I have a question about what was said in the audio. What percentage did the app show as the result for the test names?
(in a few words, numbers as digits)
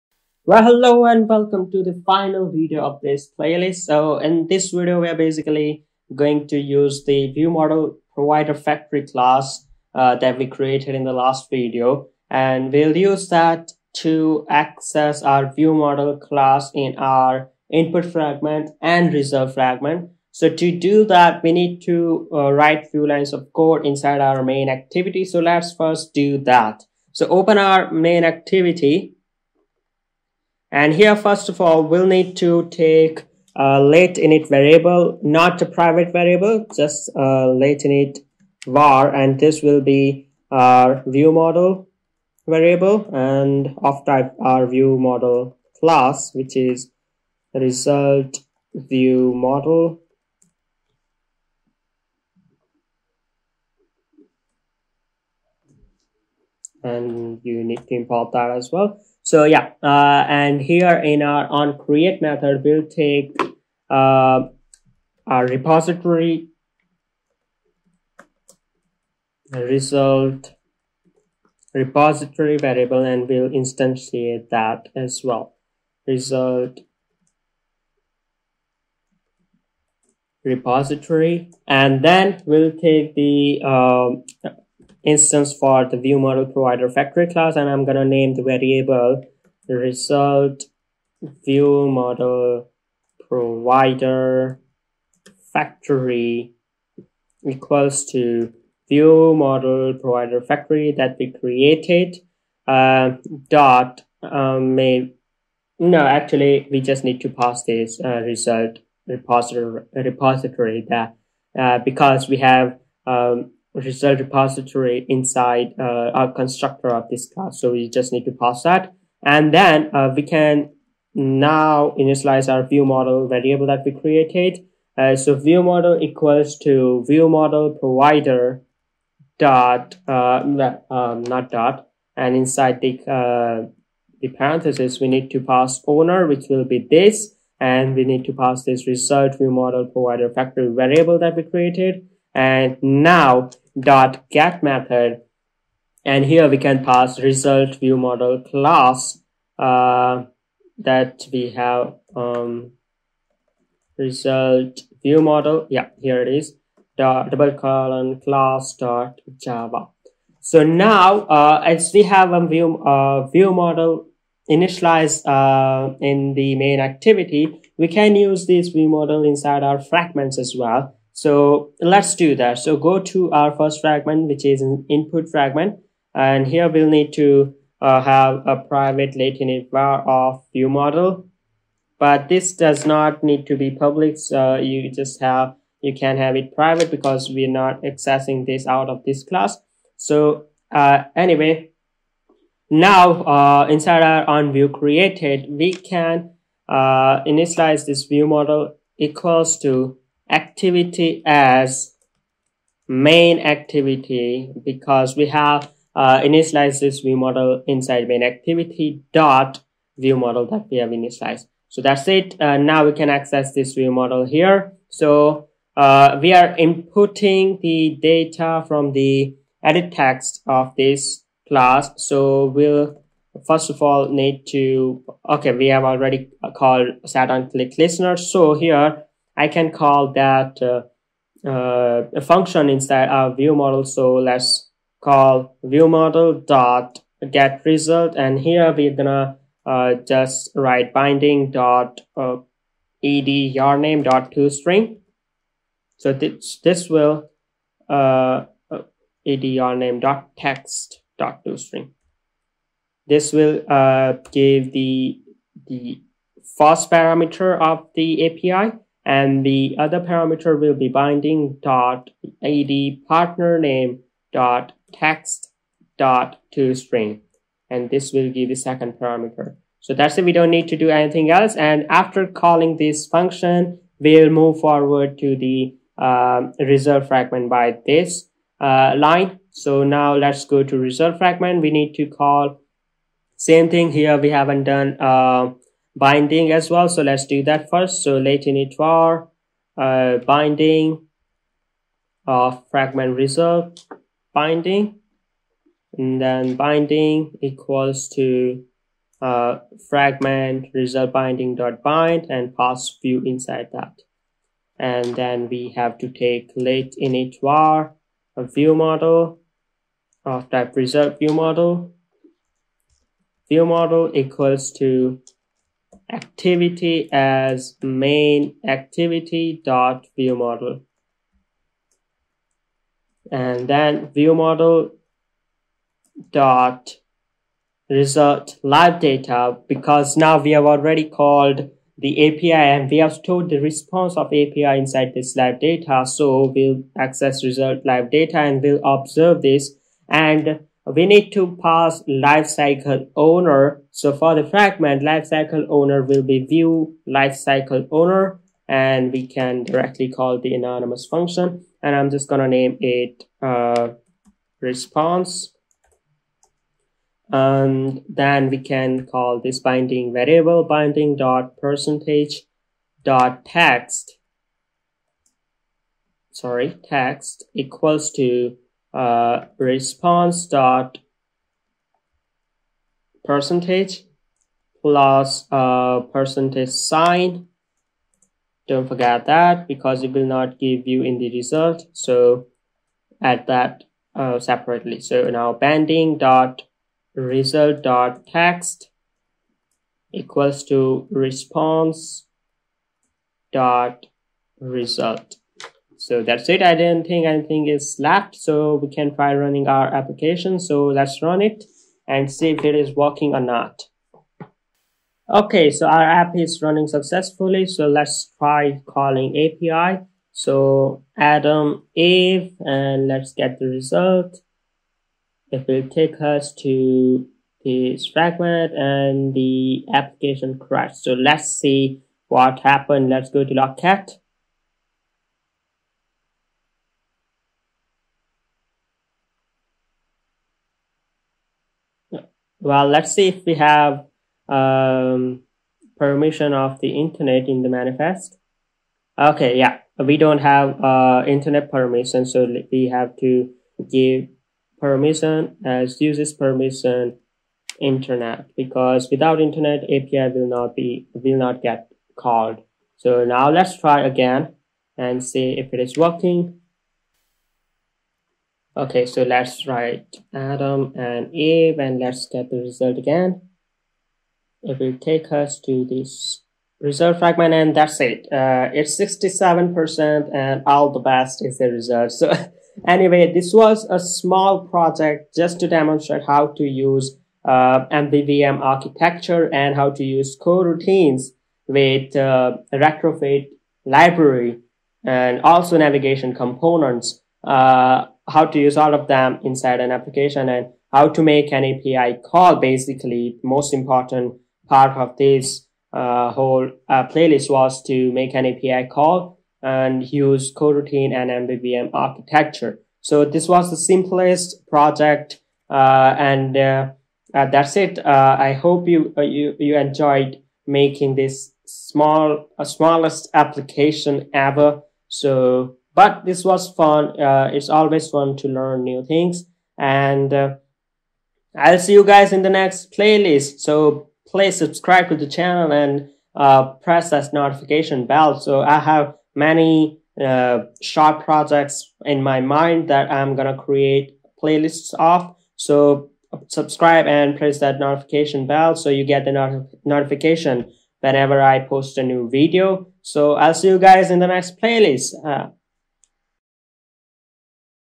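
67%.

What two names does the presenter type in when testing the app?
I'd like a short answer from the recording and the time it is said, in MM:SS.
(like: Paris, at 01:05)
Adam and Eve, at 07:40.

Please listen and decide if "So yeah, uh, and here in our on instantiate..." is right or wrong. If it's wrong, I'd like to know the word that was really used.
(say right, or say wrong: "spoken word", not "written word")
wrong: "create", not "instantiate".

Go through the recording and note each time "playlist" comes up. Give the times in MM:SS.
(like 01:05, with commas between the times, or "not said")
00:03, 08:17, 08:42, 08:54, 09:04.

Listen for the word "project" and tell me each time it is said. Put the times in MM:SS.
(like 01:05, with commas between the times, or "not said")
07:54, 08:24, 08:51.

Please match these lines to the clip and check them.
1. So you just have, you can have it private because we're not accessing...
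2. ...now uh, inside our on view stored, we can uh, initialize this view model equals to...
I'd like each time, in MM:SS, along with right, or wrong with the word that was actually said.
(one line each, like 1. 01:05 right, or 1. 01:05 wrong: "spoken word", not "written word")
1. 03:04 right
2. 03:12 wrong: "created", not "stored".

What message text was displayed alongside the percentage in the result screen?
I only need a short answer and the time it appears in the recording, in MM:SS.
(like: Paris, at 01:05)
All the best, at 07:50.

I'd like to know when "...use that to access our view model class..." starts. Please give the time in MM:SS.
00:12.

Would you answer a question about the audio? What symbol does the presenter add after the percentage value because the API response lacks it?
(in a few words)
percentage sign.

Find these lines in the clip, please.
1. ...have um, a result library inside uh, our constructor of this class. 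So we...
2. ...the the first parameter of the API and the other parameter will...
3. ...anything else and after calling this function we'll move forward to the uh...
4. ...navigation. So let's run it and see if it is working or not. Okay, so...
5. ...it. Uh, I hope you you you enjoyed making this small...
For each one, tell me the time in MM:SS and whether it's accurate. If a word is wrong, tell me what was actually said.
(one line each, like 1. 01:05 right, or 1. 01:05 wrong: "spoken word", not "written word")
1. 01:52 wrong: "repository", not "library"
2. 04:14 right
3. 04:30 right
4. 06:39 wrong: "application", not "navigation"
5. 08:27 right.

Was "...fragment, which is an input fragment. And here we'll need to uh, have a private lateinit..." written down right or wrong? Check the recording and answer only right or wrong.
right.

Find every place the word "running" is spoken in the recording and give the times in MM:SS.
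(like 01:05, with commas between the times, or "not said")
06:39, 06:46.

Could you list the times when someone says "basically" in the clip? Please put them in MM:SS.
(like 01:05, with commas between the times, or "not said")
00:05, 08:12.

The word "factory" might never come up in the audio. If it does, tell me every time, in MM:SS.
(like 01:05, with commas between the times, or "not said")
00:08, 01:26, 01:35, 01:40, 02:20.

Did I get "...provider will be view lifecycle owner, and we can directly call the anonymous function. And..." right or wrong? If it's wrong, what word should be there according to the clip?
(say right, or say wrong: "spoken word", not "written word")
wrong: "owner", not "provider".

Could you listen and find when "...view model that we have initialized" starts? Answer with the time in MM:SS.
03:29.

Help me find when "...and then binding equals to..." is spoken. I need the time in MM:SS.
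04:55.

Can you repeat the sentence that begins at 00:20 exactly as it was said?
So to do that, we need to uh, write few lines of code inside our main activity.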